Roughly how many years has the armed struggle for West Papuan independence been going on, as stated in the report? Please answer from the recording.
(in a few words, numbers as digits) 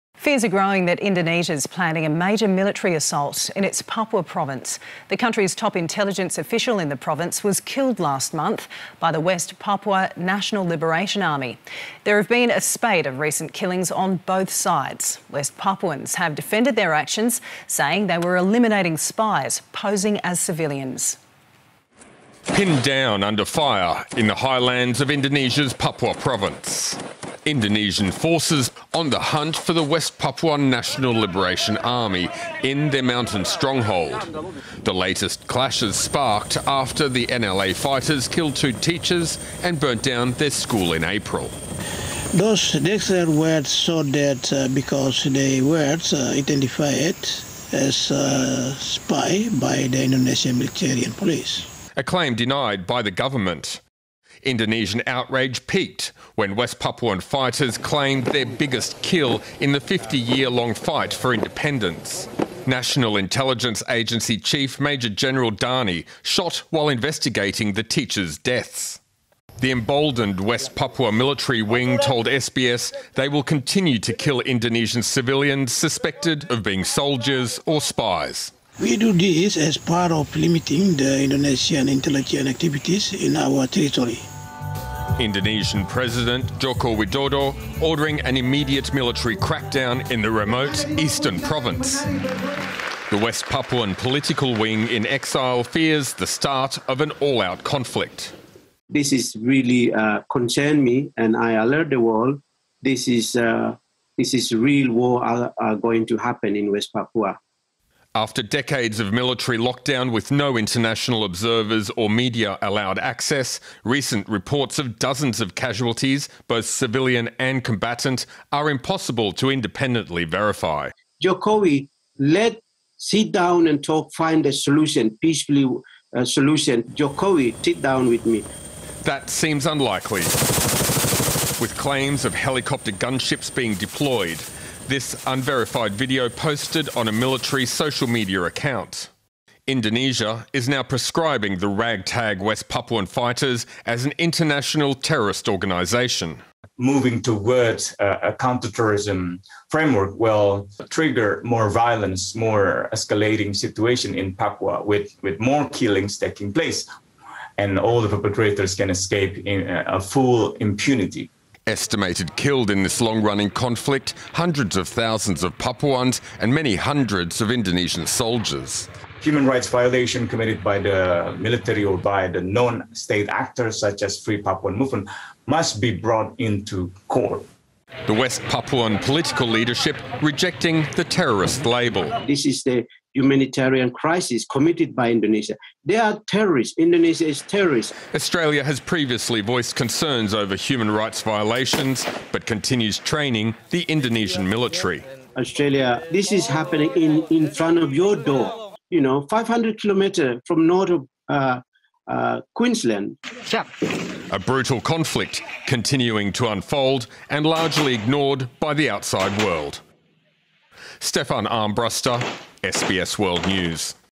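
50.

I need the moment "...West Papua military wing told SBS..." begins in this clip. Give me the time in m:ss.
1:10.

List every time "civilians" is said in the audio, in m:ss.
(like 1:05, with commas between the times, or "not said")
0:20, 1:15, 1:56.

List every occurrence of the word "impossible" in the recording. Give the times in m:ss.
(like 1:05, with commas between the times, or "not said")
1:58.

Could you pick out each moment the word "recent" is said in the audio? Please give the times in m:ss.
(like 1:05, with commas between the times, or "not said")
0:13, 1:53.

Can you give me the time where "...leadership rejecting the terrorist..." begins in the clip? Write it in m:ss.
2:59.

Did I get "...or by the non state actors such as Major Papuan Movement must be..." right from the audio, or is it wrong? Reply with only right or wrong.
wrong.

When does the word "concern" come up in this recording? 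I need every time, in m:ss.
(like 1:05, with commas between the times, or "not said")
1:40, 3:09.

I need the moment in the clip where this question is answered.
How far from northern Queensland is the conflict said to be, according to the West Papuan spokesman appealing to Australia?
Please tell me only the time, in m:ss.
3:19.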